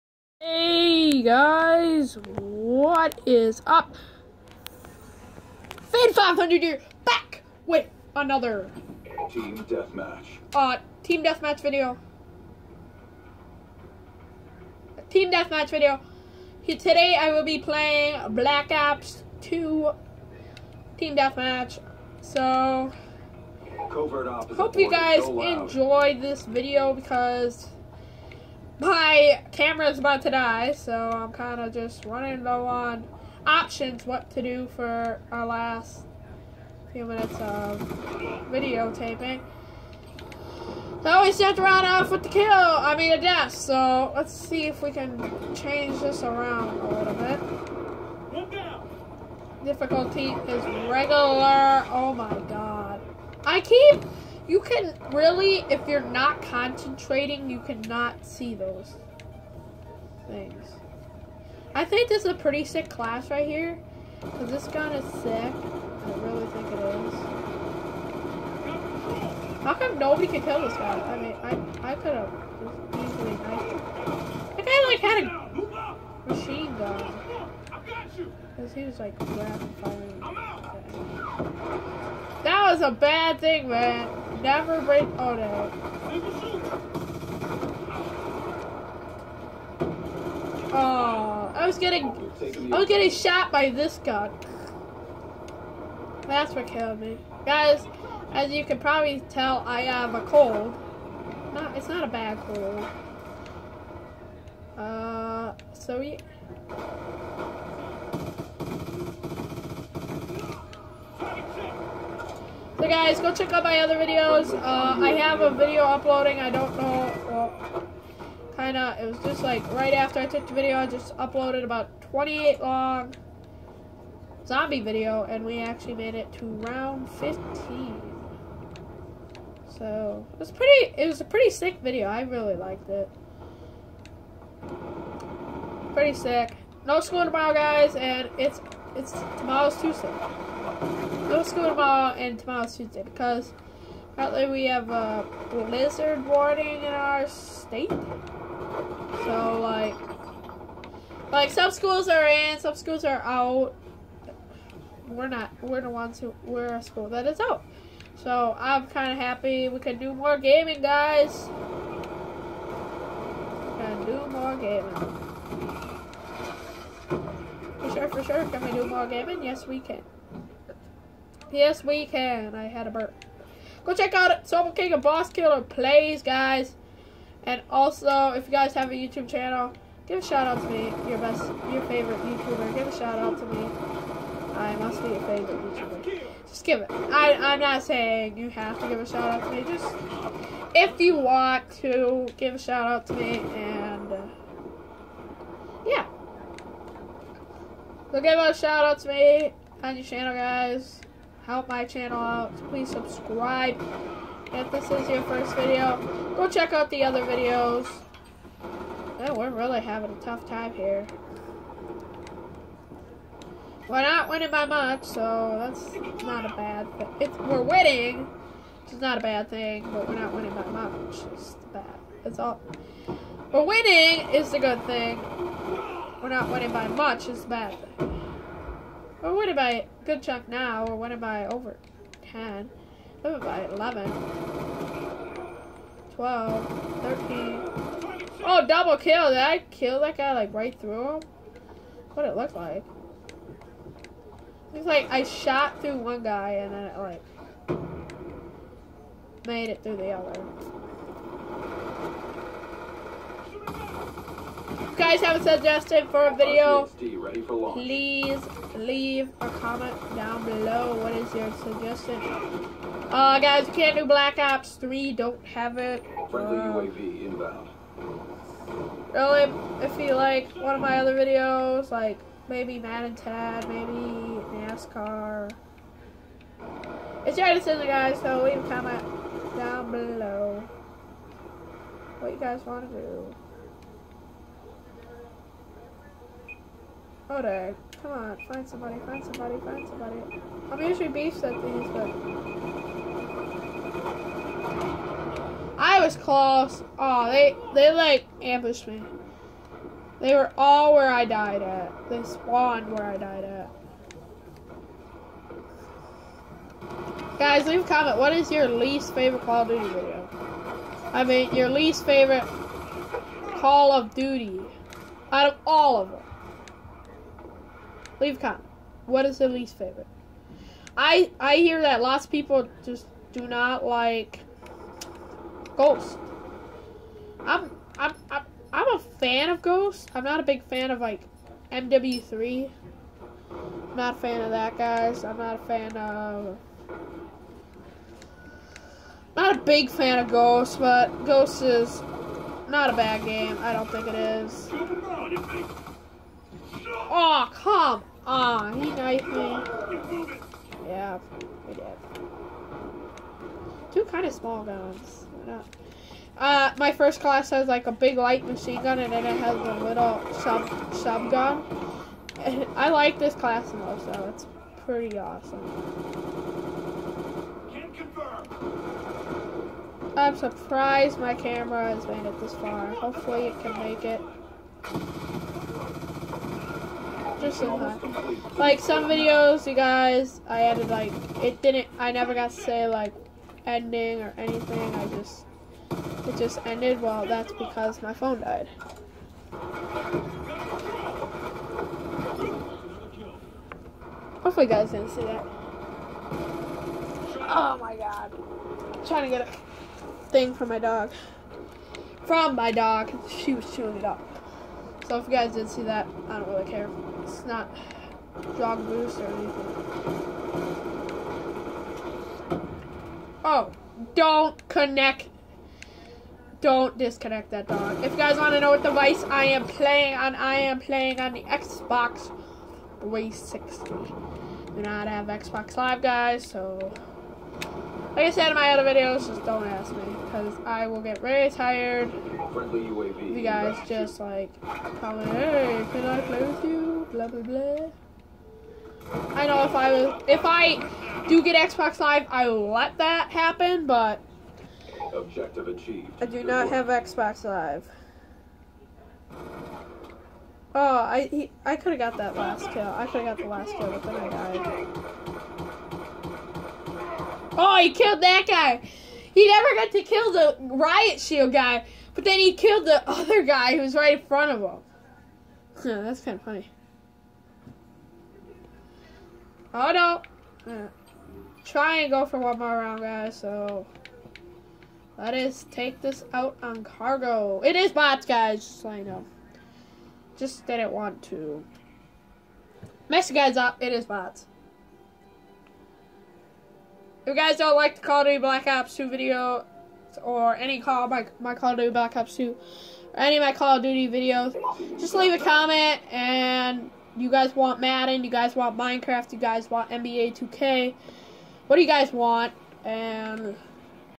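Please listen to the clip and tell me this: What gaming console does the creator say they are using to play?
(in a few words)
Xbox 360.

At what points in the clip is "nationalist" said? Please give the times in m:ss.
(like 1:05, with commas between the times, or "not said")
not said.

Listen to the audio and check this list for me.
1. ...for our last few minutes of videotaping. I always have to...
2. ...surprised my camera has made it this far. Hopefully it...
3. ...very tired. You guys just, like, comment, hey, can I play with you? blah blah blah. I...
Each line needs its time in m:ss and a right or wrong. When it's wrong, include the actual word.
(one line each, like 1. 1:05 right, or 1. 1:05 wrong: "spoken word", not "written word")
1. 0:34 right
2. 6:10 right
3. 7:11 right.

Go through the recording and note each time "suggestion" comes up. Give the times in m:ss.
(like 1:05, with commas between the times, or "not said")
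4:15, 4:21.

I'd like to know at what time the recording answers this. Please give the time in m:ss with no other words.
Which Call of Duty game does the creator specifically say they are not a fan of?
5:31.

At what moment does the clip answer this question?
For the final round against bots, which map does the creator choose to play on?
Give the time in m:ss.
7:56.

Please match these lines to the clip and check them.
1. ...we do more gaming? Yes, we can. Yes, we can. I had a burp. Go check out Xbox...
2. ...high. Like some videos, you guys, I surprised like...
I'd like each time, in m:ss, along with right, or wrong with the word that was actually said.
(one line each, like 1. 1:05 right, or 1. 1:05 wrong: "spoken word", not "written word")
1. 2:48 wrong: "Soul", not "Xbox"
2. 6:17 wrong: "added", not "surprised".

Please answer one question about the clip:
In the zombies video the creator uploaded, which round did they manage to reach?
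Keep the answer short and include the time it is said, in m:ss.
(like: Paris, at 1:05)
15, at 2:06.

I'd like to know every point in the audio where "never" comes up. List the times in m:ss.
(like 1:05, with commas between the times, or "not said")
1:24, 6:22, 7:39.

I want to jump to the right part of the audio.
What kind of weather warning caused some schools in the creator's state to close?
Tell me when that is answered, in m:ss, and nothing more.
2:25.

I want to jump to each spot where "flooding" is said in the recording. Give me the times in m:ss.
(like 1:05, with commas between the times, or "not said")
not said.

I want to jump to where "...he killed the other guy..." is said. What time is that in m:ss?
7:42.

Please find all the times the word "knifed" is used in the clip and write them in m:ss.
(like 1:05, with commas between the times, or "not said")
5:48.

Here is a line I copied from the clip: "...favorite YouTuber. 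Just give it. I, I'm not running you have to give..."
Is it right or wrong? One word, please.
wrong.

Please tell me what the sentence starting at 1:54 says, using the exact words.
Uh, I have a video uploading.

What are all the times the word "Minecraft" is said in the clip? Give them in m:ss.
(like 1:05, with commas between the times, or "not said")
8:18.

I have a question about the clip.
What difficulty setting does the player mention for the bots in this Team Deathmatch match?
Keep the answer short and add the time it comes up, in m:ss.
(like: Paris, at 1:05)
Regular, at 0:50.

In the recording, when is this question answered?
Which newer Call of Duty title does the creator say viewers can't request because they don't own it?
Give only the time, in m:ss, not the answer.
4:24.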